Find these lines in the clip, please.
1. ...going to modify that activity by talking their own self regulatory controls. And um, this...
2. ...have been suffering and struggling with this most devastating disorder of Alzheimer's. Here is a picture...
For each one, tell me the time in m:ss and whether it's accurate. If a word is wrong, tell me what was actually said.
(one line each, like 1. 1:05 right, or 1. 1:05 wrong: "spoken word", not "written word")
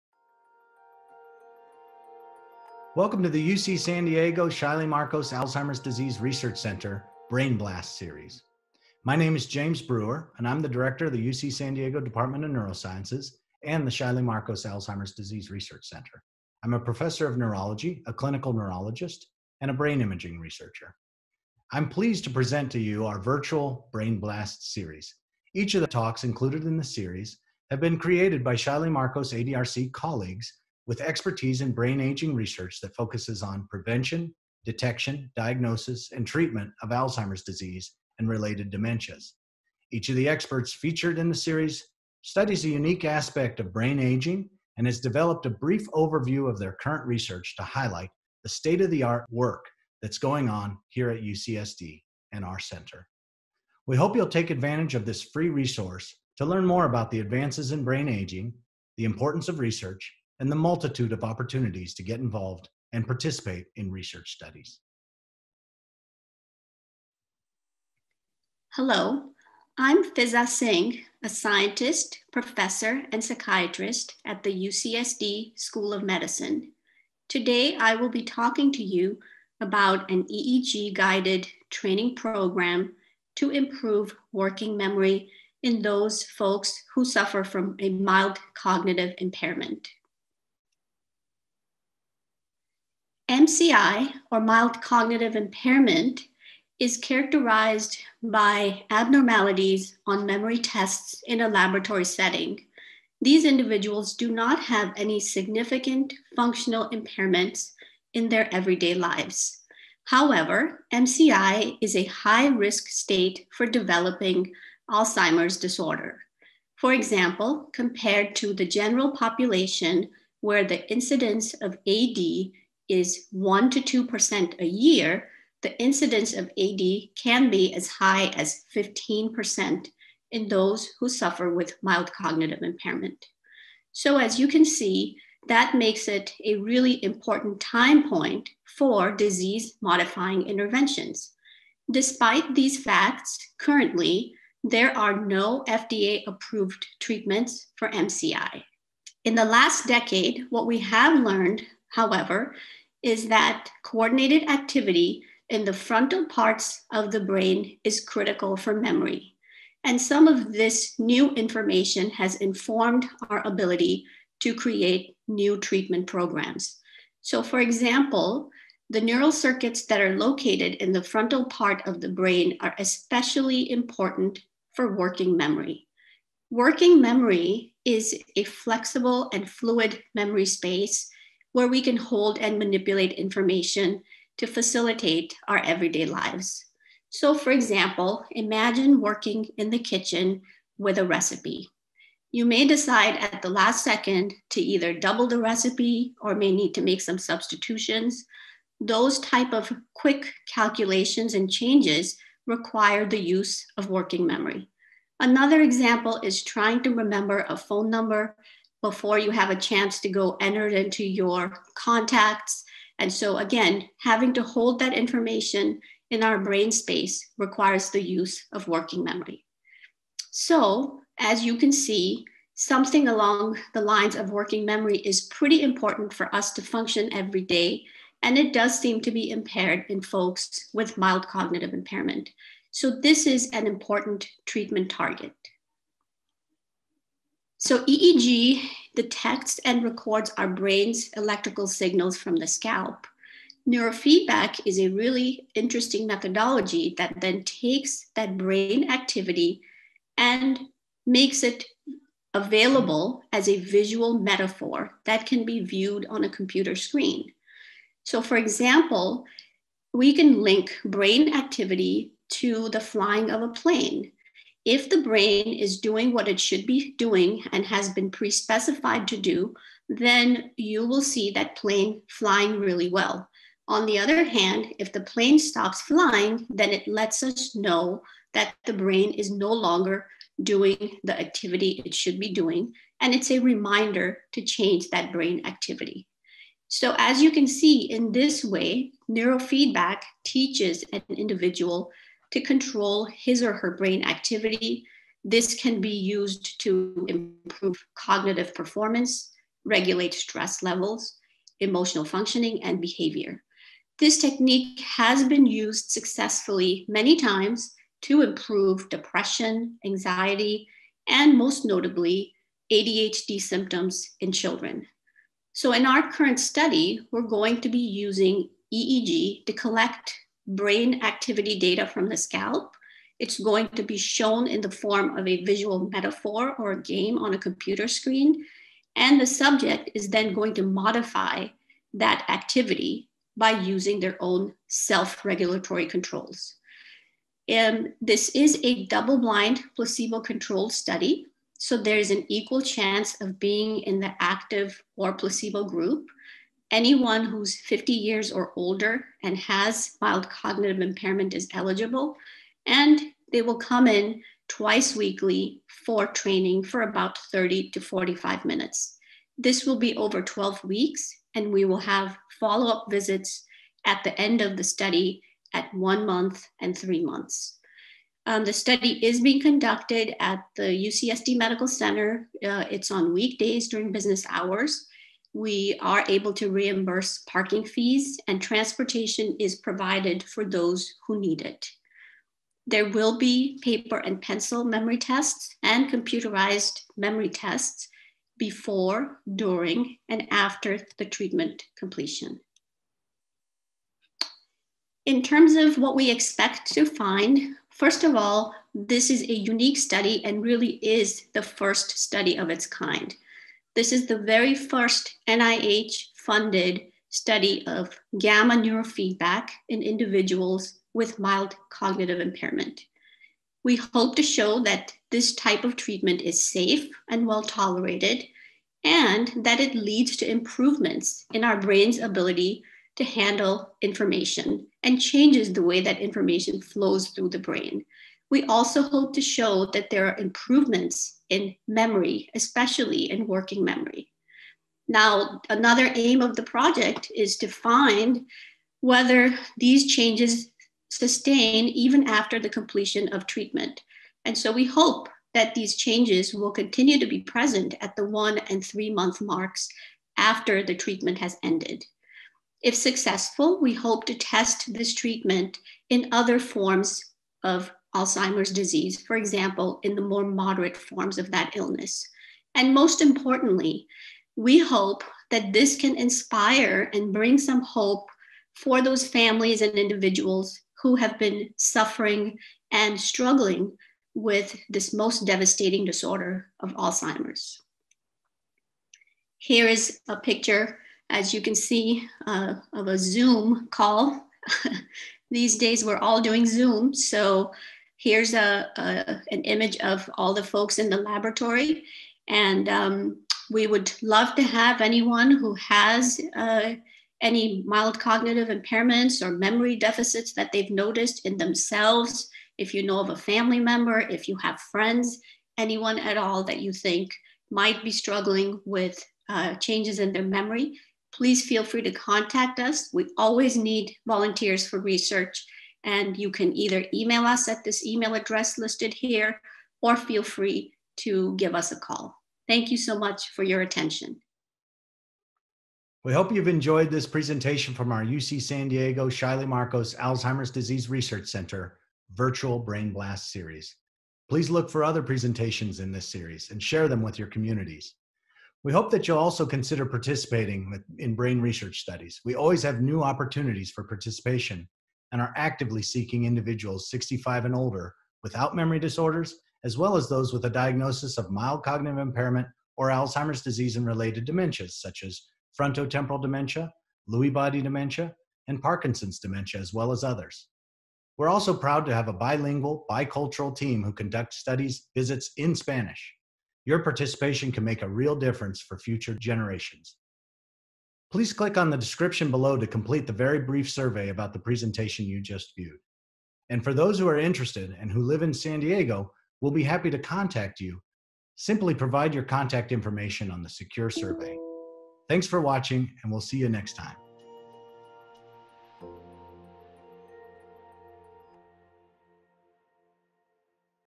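1. 5:30 wrong: "using", not "talking"
2. 7:50 right.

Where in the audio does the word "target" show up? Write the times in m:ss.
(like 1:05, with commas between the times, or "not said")
3:54.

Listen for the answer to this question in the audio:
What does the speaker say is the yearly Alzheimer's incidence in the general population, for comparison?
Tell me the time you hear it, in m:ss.
2:03.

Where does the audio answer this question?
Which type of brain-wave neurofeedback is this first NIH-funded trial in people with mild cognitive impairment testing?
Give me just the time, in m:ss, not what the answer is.
6:48.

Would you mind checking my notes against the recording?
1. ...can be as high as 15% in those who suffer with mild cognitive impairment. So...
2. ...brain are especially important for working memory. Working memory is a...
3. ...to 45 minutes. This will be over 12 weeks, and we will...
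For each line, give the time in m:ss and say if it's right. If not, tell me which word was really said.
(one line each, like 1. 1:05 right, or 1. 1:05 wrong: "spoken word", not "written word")
1. 2:07 right
2. 2:52 right
3. 5:57 right.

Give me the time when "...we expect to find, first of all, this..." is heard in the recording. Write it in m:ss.
6:35.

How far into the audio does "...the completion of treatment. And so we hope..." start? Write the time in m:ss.
7:22.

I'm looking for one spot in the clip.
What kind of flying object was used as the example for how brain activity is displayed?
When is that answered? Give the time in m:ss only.
4:23.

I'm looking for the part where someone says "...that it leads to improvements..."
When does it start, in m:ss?
6:59.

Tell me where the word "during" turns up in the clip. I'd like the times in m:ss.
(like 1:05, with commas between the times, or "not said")
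6:13, 6:29.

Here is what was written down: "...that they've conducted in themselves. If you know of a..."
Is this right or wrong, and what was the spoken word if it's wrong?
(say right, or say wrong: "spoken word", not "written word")
wrong: "noticed", not "conducted".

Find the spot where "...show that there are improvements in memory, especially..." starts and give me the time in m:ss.
7:09.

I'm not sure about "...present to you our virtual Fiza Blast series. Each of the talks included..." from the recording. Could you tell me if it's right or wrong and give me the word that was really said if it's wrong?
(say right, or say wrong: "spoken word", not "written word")
wrong: "Brain", not "Fiza".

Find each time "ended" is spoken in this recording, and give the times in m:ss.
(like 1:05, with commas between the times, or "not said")
7:31.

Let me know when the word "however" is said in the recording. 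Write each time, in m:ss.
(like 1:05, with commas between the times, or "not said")
1:50, 2:31.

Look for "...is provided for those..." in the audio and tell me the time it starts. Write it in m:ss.
6:19.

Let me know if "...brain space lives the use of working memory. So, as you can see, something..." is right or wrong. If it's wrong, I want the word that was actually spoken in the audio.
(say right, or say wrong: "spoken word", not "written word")
wrong: "requires", not "lives".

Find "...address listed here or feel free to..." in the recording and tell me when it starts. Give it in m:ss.
8:38.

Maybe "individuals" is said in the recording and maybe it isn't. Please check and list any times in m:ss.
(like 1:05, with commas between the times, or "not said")
1:43, 4:51, 6:49, 7:49, 9:06.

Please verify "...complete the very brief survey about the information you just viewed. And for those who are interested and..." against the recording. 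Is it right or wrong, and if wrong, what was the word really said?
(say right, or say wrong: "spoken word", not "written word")
wrong: "presentation", not "information".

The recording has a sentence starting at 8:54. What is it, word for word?
Please look for other presentations in this series and share them with your communities.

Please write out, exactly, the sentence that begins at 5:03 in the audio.
This technique has been used successfully many times to improve depression, anxiety, and most notably, ADHD symptoms in children.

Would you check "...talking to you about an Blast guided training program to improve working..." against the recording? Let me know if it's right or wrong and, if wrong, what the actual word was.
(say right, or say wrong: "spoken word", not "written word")
wrong: "EEG", not "Blast".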